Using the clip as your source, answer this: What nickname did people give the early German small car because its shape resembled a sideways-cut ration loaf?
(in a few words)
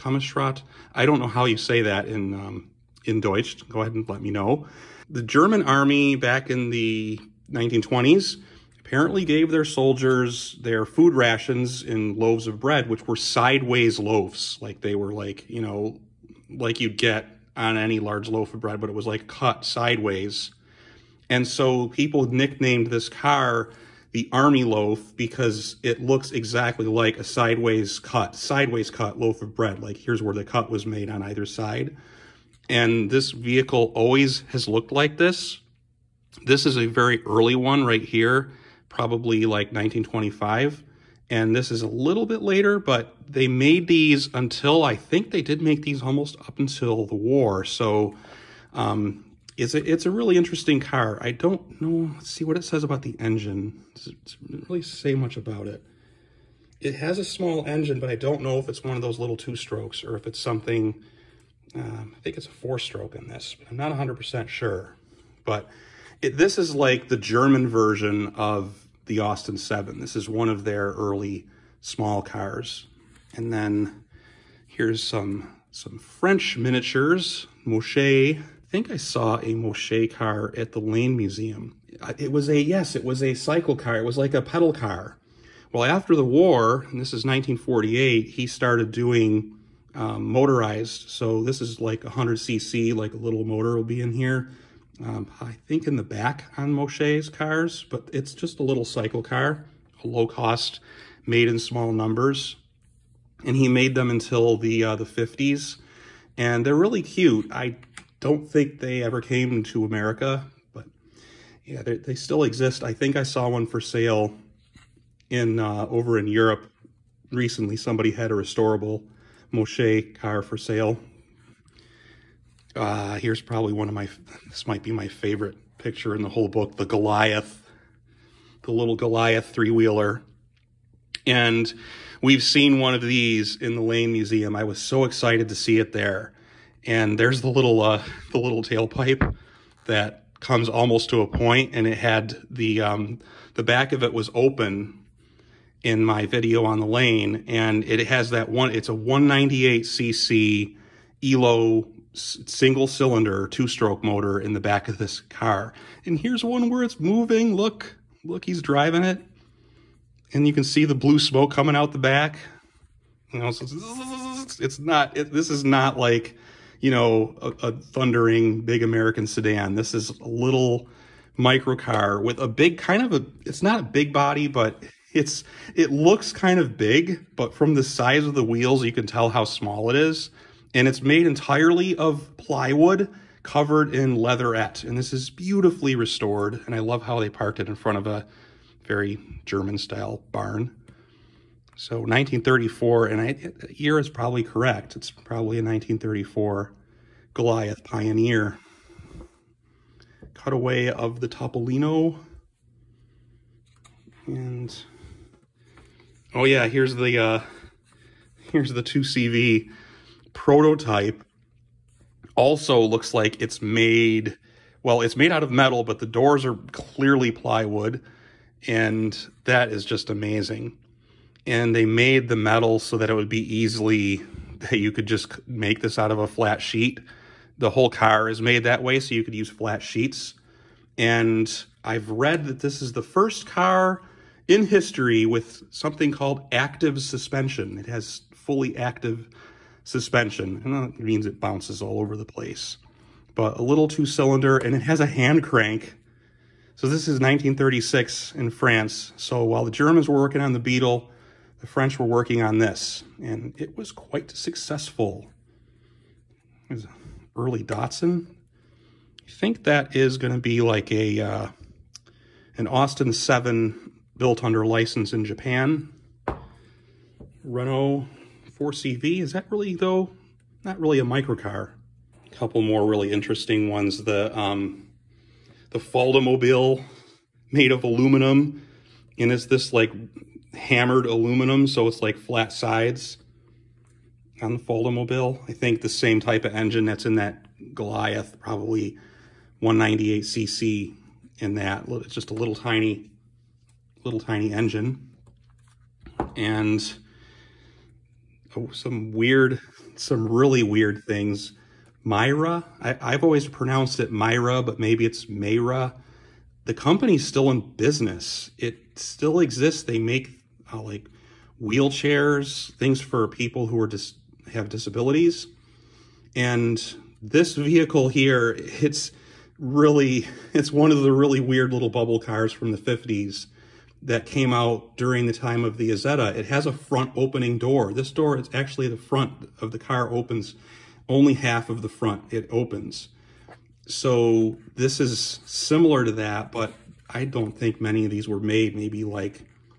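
army loaf.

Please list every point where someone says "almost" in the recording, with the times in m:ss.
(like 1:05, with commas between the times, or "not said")
0:46, 2:20.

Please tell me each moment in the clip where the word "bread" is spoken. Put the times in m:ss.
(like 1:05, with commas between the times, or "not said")
0:12, 0:18, 0:29.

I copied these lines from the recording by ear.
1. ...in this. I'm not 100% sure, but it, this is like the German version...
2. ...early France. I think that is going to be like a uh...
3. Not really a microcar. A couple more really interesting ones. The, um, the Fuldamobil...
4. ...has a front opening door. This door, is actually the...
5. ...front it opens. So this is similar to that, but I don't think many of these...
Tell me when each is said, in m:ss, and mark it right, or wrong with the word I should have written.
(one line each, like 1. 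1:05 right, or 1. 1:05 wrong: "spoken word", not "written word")
1. 1:03 right
2. 4:17 wrong: "Datsun", not "France"
3. 4:30 right
4. 5:26 right
5. 5:31 right.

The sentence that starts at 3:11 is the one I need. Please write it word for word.
So 1934, and I, year is probably correct.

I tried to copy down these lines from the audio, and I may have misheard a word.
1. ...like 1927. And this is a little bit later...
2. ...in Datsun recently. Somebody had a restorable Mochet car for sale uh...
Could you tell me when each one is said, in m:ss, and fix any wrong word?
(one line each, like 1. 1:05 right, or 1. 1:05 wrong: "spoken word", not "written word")
1. 0:39 wrong: "1925", not "1927"
2. 1:56 wrong: "Europe", not "Datsun".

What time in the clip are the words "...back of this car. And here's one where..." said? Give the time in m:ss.
2:34.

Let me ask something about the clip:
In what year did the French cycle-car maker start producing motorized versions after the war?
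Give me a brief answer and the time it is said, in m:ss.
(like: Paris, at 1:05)
1948, at 1:27.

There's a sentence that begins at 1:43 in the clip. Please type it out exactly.
And he made them until the uh, the 50s, and they're really cute.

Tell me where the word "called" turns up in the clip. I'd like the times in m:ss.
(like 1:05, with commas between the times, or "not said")
3:56.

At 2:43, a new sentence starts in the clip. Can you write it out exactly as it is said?
You know, so it's, it's not, it, this is not like, you know, a, a thundering big American sedan.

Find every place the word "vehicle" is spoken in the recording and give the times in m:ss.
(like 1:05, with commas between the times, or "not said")
0:33, 5:17.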